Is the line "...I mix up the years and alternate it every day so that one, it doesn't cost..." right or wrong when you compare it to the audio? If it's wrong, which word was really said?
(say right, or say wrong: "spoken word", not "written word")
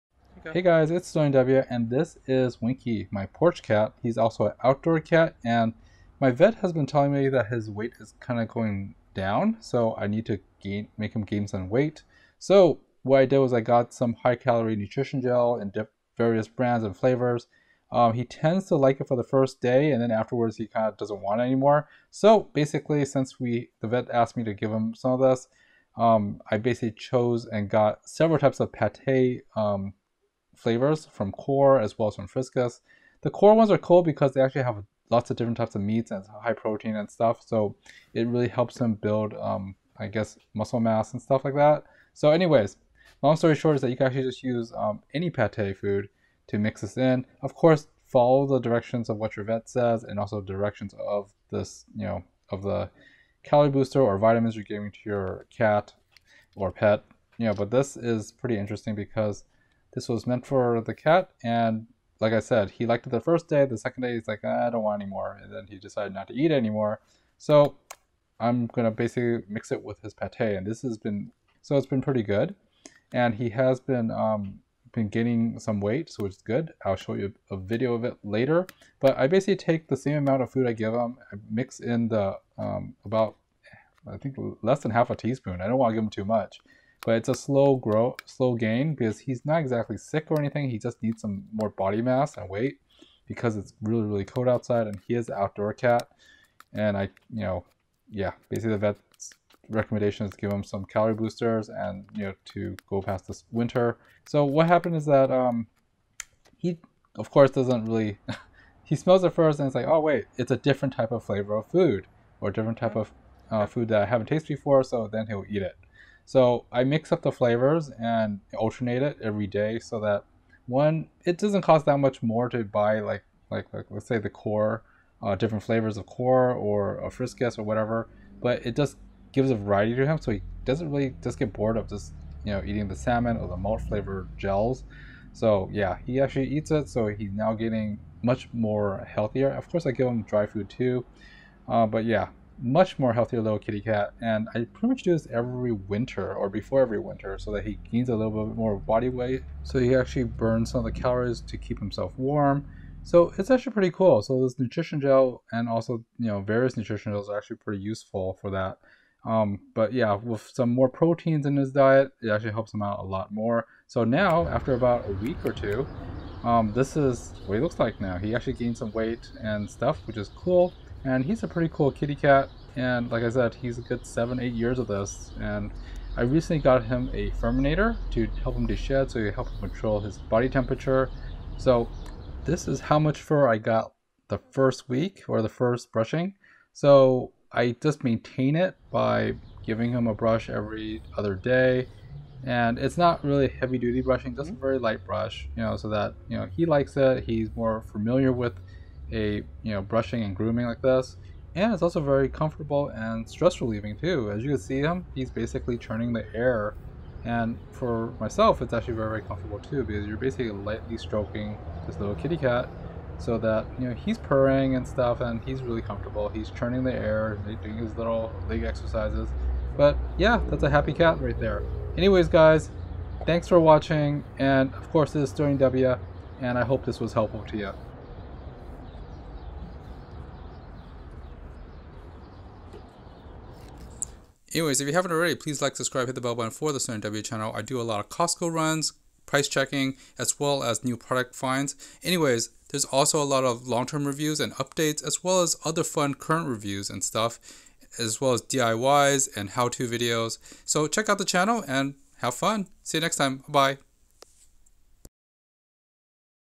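wrong: "flavors", not "years".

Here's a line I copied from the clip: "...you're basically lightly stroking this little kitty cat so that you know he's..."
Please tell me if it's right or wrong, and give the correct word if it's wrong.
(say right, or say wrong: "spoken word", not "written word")
right.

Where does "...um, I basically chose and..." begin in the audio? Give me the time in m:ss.
0:25.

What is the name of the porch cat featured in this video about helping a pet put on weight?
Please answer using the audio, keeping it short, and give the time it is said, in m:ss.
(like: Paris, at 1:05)
Winky, at 0:02.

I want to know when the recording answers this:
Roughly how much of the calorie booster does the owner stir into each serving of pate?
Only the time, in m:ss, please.
1:24.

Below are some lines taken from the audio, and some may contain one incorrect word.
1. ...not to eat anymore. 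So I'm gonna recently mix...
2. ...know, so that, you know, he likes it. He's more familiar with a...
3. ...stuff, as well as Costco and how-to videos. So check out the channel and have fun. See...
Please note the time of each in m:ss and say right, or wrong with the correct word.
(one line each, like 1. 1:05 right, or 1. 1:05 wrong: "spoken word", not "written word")
1. 1:06 wrong: "basically", not "recently"
2. 3:15 right
3. 4:07 wrong: "DIYs", not "Costco".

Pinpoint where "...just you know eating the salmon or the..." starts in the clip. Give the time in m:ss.
2:11.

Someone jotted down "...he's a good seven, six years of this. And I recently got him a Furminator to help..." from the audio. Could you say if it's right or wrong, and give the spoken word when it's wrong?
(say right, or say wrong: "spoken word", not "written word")
wrong: "eight", not "six".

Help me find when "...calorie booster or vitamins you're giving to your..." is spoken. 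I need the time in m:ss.
0:53.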